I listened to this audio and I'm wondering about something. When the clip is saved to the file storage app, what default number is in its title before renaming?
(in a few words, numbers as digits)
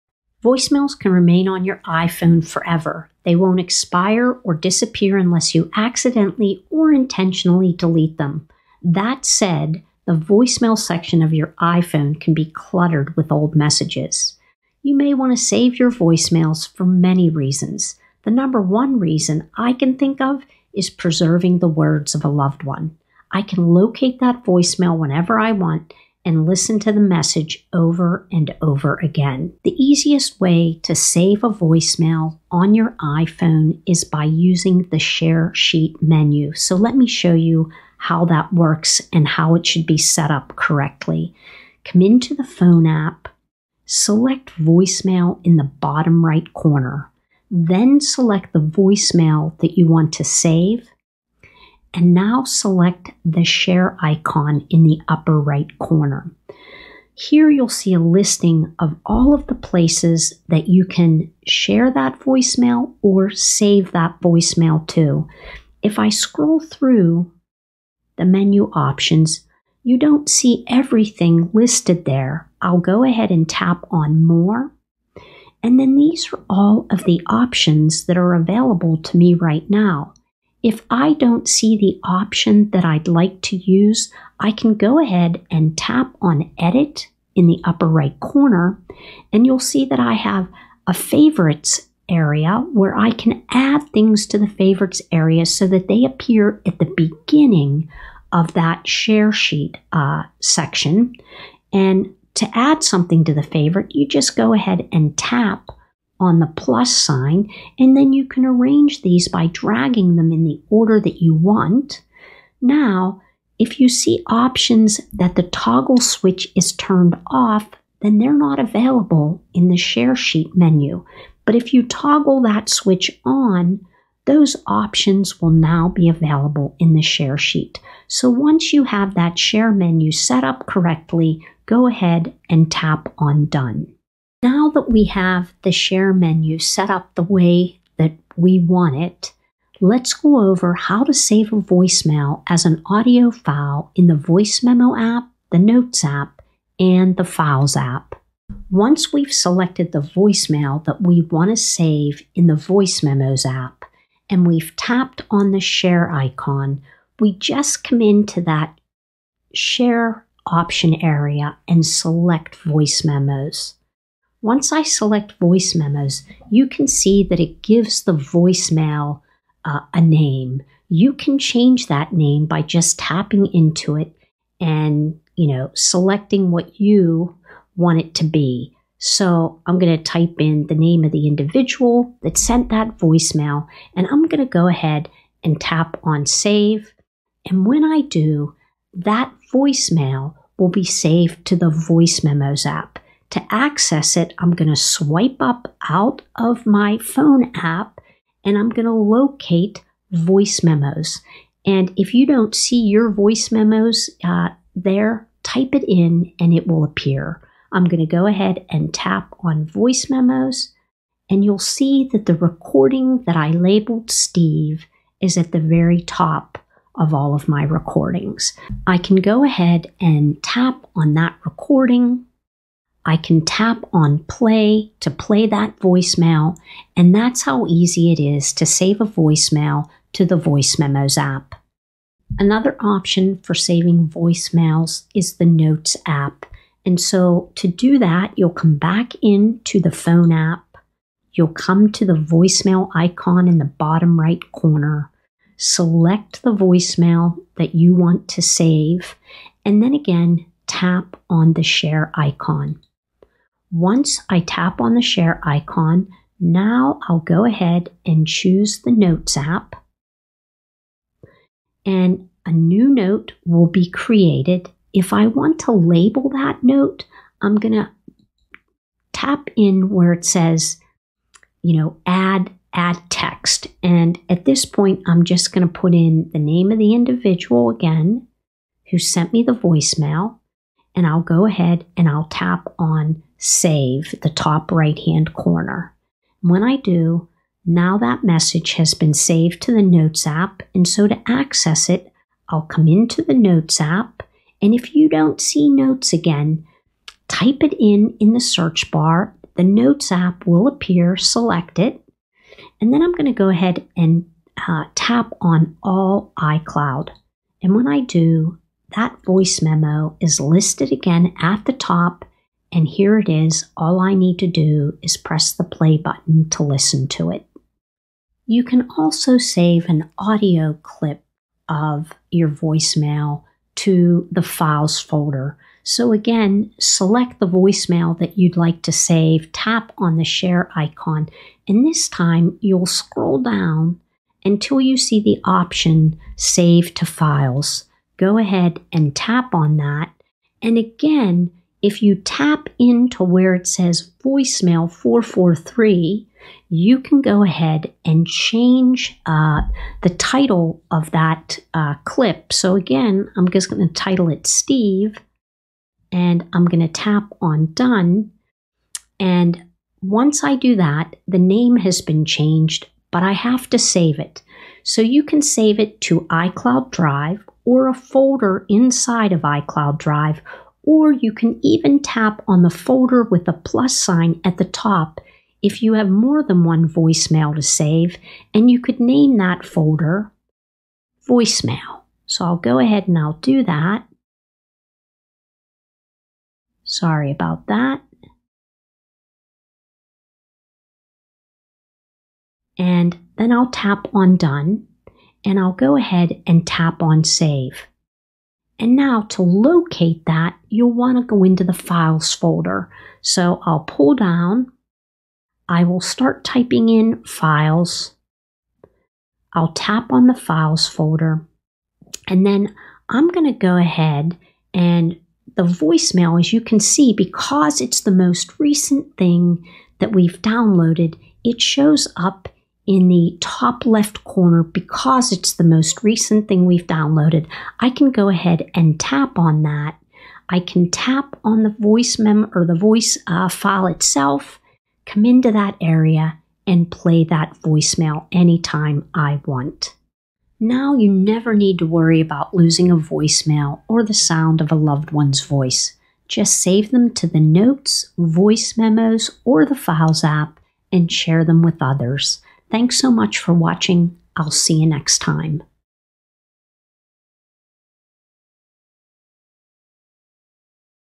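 443.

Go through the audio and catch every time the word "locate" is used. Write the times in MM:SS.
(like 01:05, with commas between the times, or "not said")
00:23, 03:18, 06:39.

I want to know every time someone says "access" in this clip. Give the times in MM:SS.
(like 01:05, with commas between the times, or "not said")
03:13, 04:51.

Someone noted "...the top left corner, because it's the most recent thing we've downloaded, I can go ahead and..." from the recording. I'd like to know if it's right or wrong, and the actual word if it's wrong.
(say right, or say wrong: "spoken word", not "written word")
right.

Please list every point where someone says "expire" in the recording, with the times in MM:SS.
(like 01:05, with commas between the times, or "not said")
00:03.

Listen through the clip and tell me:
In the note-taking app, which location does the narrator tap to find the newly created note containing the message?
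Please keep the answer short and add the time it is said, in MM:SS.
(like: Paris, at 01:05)
All iCloud, at 05:05.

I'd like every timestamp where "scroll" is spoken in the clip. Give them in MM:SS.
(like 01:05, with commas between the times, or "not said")
01:06, 05:32.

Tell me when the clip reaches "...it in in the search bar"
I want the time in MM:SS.
04:57.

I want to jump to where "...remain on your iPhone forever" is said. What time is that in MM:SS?
00:01.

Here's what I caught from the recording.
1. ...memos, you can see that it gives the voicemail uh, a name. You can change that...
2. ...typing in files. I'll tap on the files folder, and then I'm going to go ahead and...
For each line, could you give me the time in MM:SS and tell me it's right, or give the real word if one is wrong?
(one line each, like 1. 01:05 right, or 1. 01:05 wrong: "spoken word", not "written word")
1. 02:45 right
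2. 06:46 right.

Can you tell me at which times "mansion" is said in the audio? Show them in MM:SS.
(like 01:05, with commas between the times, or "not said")
not said.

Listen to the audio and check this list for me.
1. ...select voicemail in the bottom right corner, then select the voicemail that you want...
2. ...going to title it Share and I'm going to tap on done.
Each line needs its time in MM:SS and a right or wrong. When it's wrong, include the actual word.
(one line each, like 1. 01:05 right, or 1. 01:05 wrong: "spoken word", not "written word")
1. 00:43 right
2. 05:53 wrong: "Steve", not "Share".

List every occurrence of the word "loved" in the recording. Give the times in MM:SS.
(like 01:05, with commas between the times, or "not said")
00:22, 07:24.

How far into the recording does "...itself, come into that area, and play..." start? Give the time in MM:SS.
07:13.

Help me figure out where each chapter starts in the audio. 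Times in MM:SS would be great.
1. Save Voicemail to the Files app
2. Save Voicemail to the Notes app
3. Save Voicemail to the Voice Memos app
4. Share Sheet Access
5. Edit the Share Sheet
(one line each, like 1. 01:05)
1. 05:18
2. 03:51
3. 02:16
4. 00:29
5. 01:23.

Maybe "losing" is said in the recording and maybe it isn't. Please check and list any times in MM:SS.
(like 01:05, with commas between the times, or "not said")
07:22.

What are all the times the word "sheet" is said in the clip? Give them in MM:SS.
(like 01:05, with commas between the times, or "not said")
00:35, 01:39, 02:00, 02:07.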